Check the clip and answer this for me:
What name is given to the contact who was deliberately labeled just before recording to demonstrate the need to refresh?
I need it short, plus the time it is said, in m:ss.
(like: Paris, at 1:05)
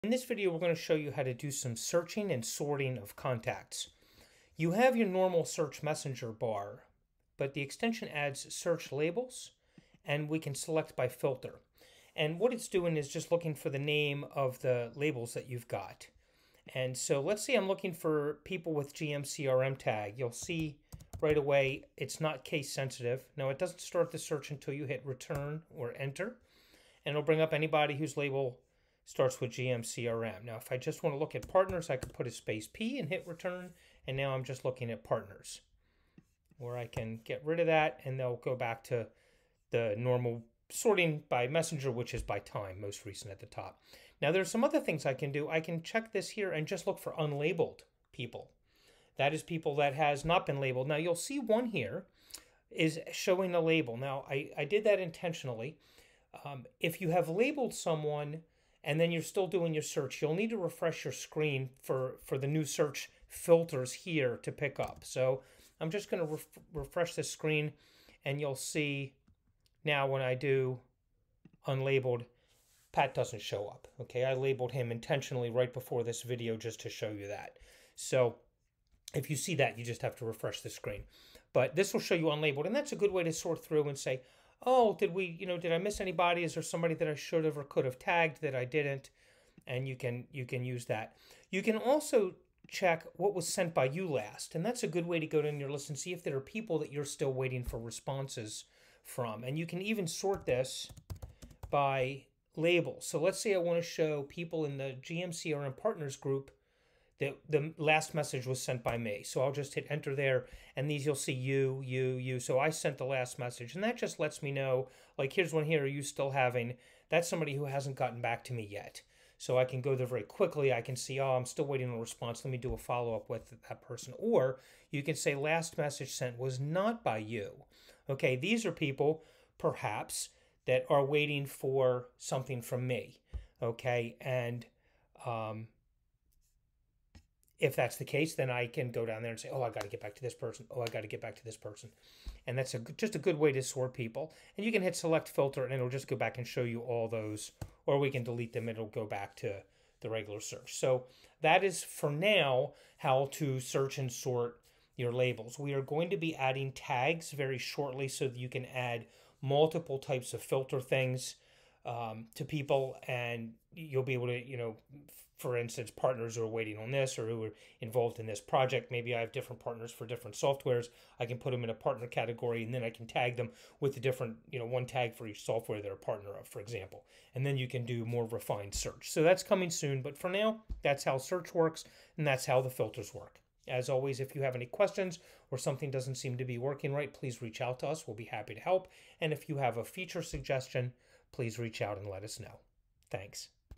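Pat, at 1:12.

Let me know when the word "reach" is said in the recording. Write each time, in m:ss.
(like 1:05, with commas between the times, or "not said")
3:07, 3:11.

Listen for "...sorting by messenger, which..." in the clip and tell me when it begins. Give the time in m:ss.
0:40.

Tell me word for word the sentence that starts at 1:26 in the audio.
Is there somebody that I should have or could have tagged that I didn't?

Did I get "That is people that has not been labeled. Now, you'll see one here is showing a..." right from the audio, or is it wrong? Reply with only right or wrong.
right.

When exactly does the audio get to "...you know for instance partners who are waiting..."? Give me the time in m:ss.
2:44.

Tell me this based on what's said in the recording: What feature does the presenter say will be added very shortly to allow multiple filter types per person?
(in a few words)
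Tags.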